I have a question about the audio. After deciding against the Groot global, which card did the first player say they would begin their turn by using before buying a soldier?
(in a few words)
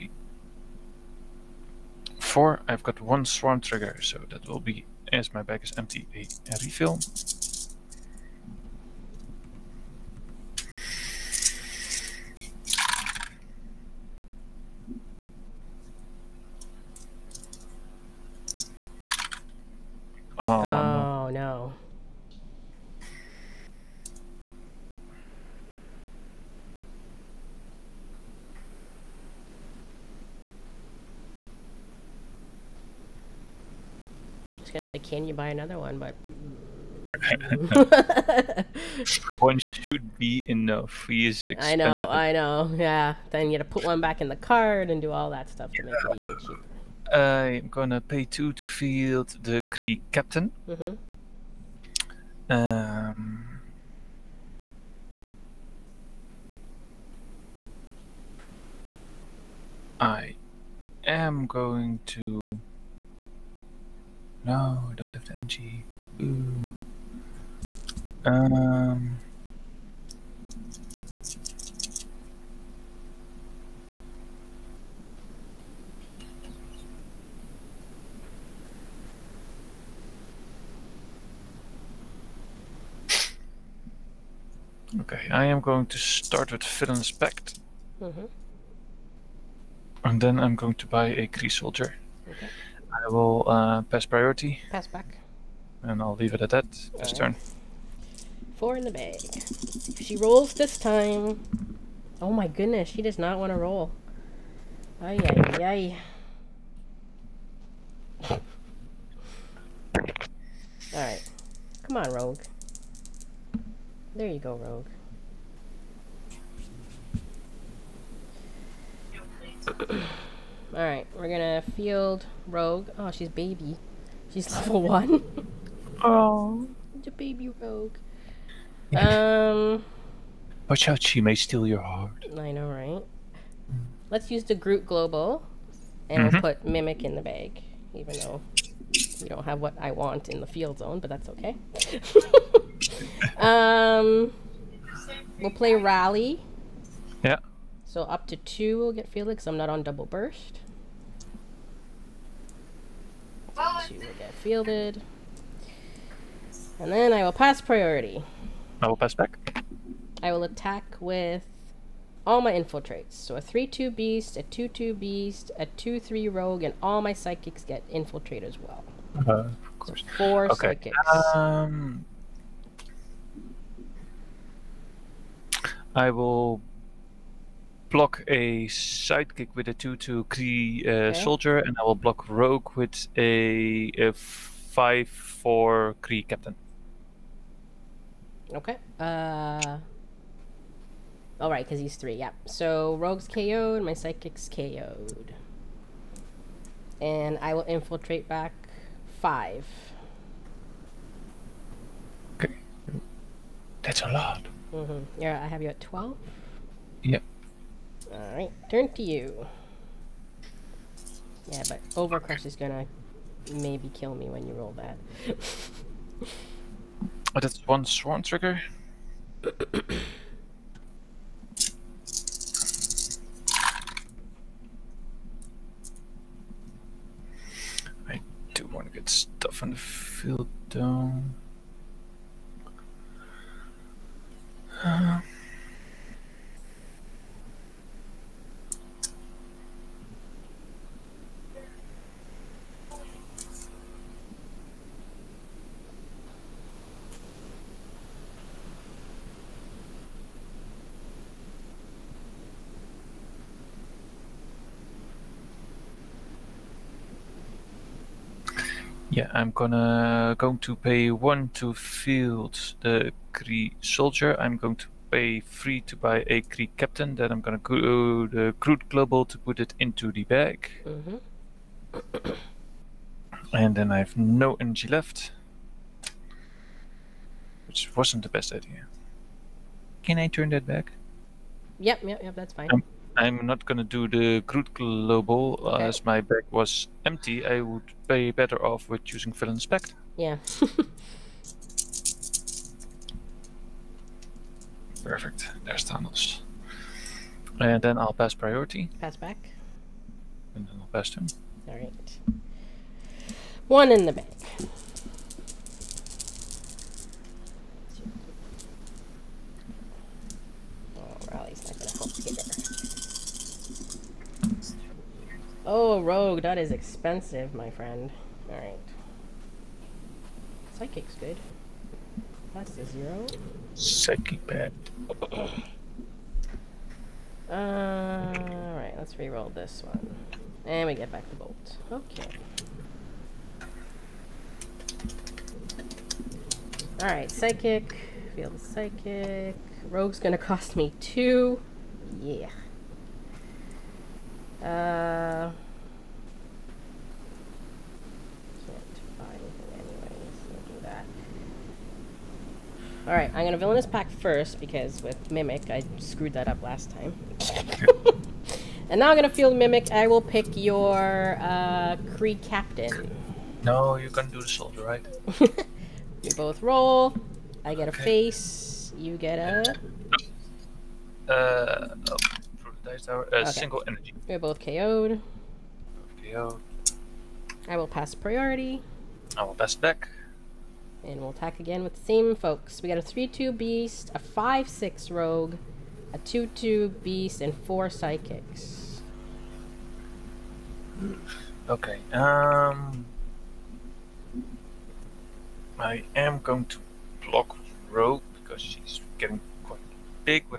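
Villain's Pact.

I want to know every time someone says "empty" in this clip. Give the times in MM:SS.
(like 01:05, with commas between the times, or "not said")
00:05, 04:47.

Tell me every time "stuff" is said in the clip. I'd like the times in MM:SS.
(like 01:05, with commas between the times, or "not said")
00:45, 03:49.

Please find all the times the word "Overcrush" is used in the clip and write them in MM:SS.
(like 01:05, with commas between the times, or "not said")
03:31.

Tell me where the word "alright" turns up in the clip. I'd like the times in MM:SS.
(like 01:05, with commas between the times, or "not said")
01:50, 02:00, 03:28, 05:18, 05:27, 05:36, 05:53.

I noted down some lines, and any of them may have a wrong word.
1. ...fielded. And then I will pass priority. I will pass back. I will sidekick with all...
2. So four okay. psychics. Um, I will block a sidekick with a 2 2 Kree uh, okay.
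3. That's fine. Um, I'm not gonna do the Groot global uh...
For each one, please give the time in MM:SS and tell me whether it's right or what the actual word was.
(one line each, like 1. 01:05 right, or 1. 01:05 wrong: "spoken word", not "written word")
1. 02:34 wrong: "attack", not "sidekick"
2. 02:50 right
3. 04:42 right.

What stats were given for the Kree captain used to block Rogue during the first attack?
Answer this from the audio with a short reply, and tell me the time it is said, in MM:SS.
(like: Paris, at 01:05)
5 4, at 03:04.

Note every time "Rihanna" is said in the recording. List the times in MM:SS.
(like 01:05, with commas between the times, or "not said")
not said.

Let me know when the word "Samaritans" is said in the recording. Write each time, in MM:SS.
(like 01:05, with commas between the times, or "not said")
not said.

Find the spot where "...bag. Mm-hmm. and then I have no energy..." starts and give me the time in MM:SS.
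04:30.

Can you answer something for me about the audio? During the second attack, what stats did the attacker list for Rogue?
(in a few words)
5-6.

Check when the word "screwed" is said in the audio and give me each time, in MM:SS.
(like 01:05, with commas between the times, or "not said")
05:55.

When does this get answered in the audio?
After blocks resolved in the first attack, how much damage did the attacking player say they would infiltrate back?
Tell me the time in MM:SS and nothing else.
03:19.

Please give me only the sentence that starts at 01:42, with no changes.
Oh my goodness, she does not want to roll.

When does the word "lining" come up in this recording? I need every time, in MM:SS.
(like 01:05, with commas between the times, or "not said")
not said.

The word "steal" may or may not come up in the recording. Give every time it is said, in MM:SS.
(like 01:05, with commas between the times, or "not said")
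02:11.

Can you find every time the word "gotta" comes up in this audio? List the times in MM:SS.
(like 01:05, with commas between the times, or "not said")
00:43.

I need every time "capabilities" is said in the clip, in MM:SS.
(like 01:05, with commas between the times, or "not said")
not said.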